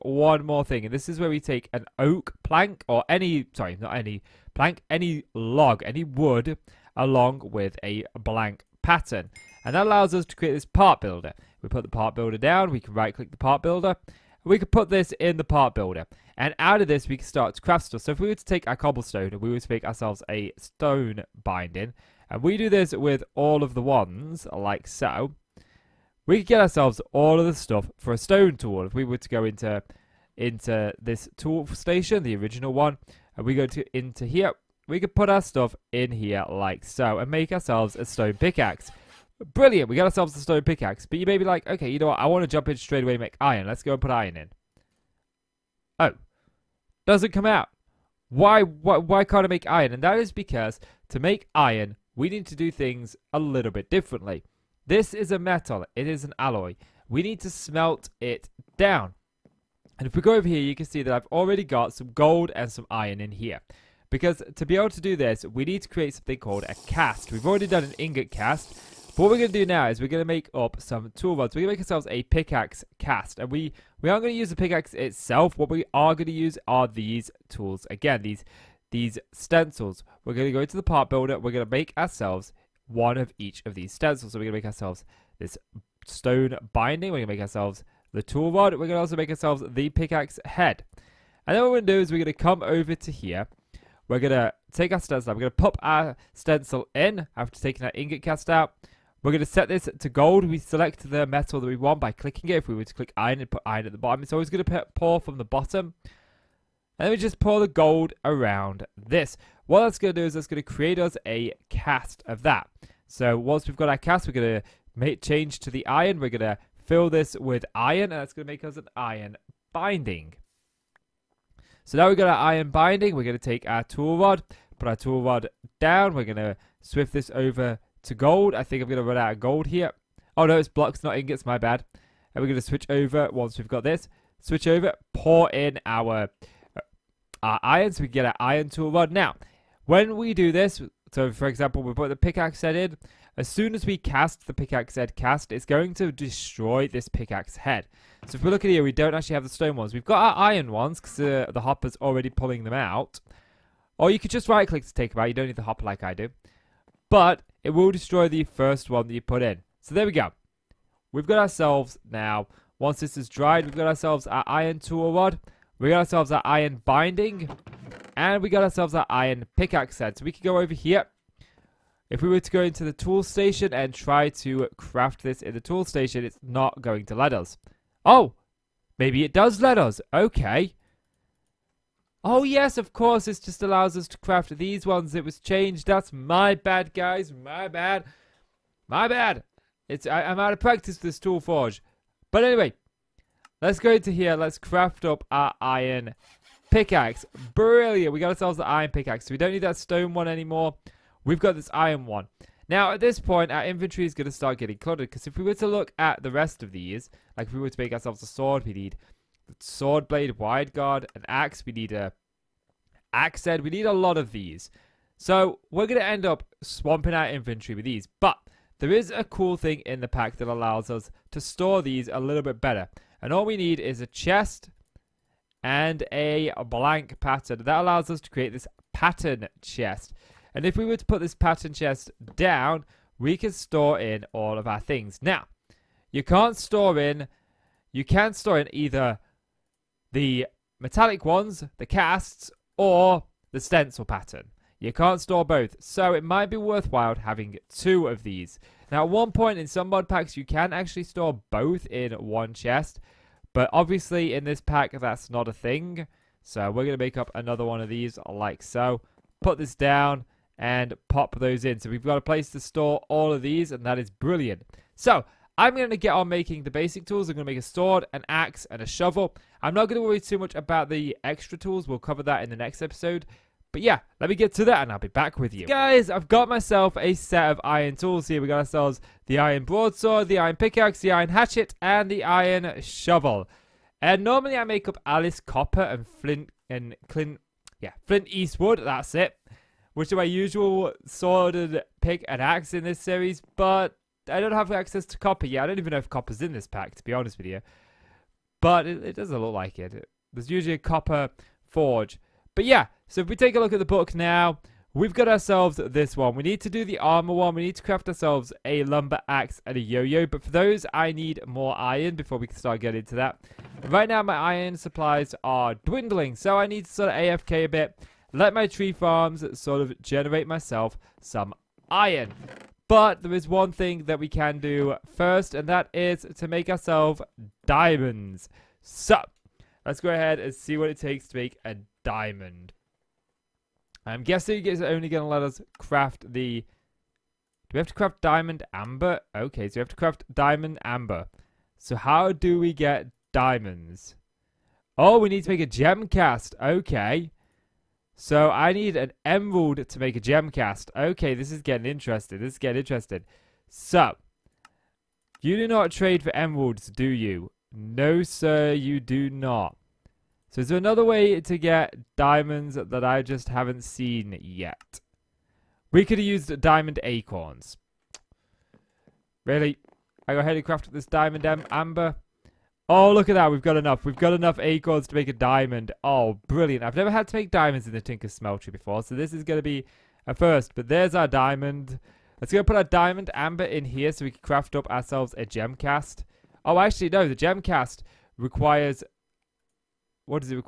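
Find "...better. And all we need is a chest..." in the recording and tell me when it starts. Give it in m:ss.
3:42.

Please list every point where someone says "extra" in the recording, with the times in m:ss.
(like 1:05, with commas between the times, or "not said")
4:31.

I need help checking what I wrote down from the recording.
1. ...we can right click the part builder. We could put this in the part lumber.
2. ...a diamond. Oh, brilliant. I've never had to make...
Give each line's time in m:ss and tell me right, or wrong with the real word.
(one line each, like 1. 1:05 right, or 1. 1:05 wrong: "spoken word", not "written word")
1. 0:12 wrong: "builder", not "lumber"
2. 6:15 right.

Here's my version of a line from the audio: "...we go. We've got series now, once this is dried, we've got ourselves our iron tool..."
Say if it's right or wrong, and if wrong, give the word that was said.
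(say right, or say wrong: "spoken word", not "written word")
wrong: "ourselves", not "series".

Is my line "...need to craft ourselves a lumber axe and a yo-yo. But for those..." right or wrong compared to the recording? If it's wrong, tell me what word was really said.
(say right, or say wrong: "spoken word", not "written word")
right.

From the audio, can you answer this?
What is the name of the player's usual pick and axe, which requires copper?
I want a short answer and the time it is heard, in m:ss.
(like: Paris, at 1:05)
Flint Eastwood, at 4:48.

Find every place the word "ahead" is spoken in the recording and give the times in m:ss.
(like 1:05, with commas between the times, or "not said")
5:30, 6:10.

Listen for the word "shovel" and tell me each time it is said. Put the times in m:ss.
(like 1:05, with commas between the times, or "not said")
4:28, 4:42.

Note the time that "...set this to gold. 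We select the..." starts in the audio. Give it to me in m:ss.
1:39.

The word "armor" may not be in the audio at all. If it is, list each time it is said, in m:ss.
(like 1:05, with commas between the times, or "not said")
5:06.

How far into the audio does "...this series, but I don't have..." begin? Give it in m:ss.
4:52.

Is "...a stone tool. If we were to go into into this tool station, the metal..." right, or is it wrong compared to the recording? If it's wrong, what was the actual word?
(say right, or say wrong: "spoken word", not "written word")
wrong: "original", not "metal".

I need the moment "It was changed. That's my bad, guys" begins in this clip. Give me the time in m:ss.
3:05.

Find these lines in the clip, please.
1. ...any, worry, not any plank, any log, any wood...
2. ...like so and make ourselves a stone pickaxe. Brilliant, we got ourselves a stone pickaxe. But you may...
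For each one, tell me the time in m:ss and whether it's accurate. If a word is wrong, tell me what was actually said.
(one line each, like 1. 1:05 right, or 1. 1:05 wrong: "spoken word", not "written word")
1. 0:03 wrong: "sorry", not "worry"
2. 0:36 right.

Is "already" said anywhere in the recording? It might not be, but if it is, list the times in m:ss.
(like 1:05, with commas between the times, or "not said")
1:01, 1:07, 2:32.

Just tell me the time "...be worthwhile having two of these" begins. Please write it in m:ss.
4:06.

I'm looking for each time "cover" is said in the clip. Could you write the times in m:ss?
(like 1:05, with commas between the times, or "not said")
4:31.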